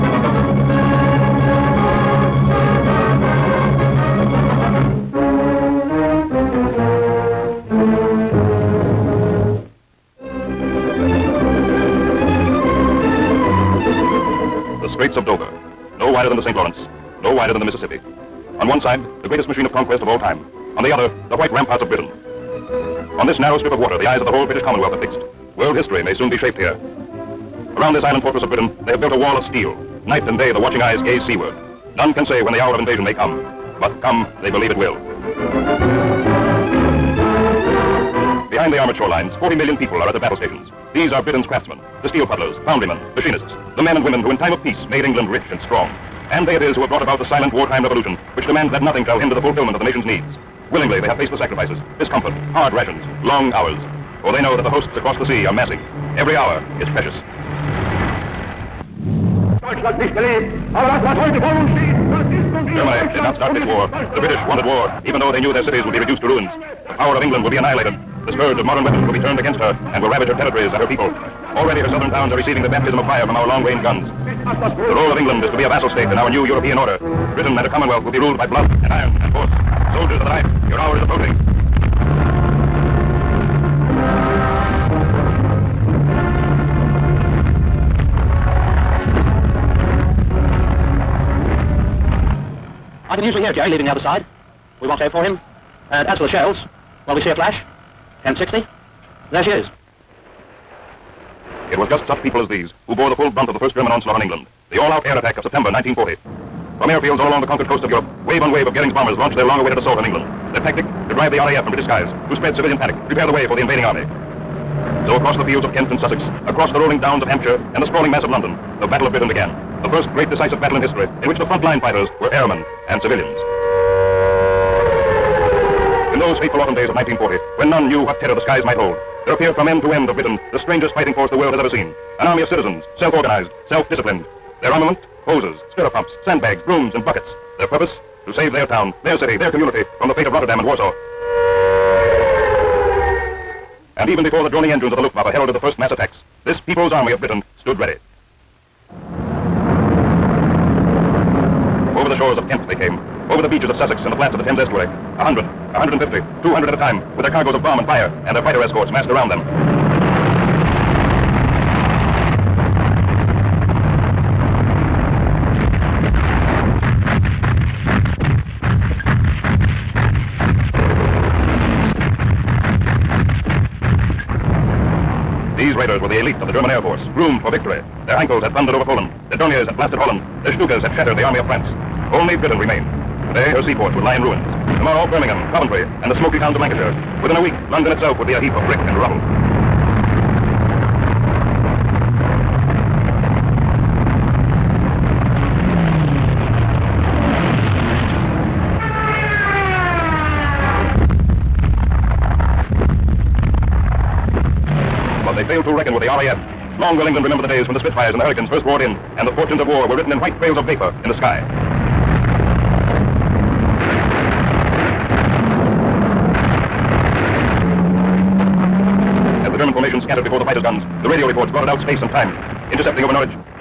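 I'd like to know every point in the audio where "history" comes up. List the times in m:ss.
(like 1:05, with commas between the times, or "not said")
0:25, 2:00.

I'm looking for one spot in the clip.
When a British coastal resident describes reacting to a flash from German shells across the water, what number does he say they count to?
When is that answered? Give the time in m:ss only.
1:38.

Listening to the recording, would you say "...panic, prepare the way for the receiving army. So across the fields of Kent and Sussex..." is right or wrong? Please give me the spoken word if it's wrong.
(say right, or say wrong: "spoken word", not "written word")
wrong: "invading", not "receiving".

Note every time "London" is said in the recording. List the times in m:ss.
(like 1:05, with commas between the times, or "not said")
1:58, 3:07.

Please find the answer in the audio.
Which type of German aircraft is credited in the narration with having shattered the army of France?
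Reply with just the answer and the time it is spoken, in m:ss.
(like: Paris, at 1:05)
Stukas, at 3:00.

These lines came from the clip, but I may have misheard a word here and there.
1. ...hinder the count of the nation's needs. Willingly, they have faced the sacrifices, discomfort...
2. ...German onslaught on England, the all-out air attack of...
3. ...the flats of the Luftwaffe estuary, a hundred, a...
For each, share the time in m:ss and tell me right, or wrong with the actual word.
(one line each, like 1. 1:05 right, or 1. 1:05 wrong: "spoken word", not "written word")
1. 0:49 wrong: "fulfillment", not "count"
2. 1:43 right
3. 2:34 wrong: "Thames", not "Luftwaffe".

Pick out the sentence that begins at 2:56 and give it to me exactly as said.
were the elite of the German Air Force, groomed for victory.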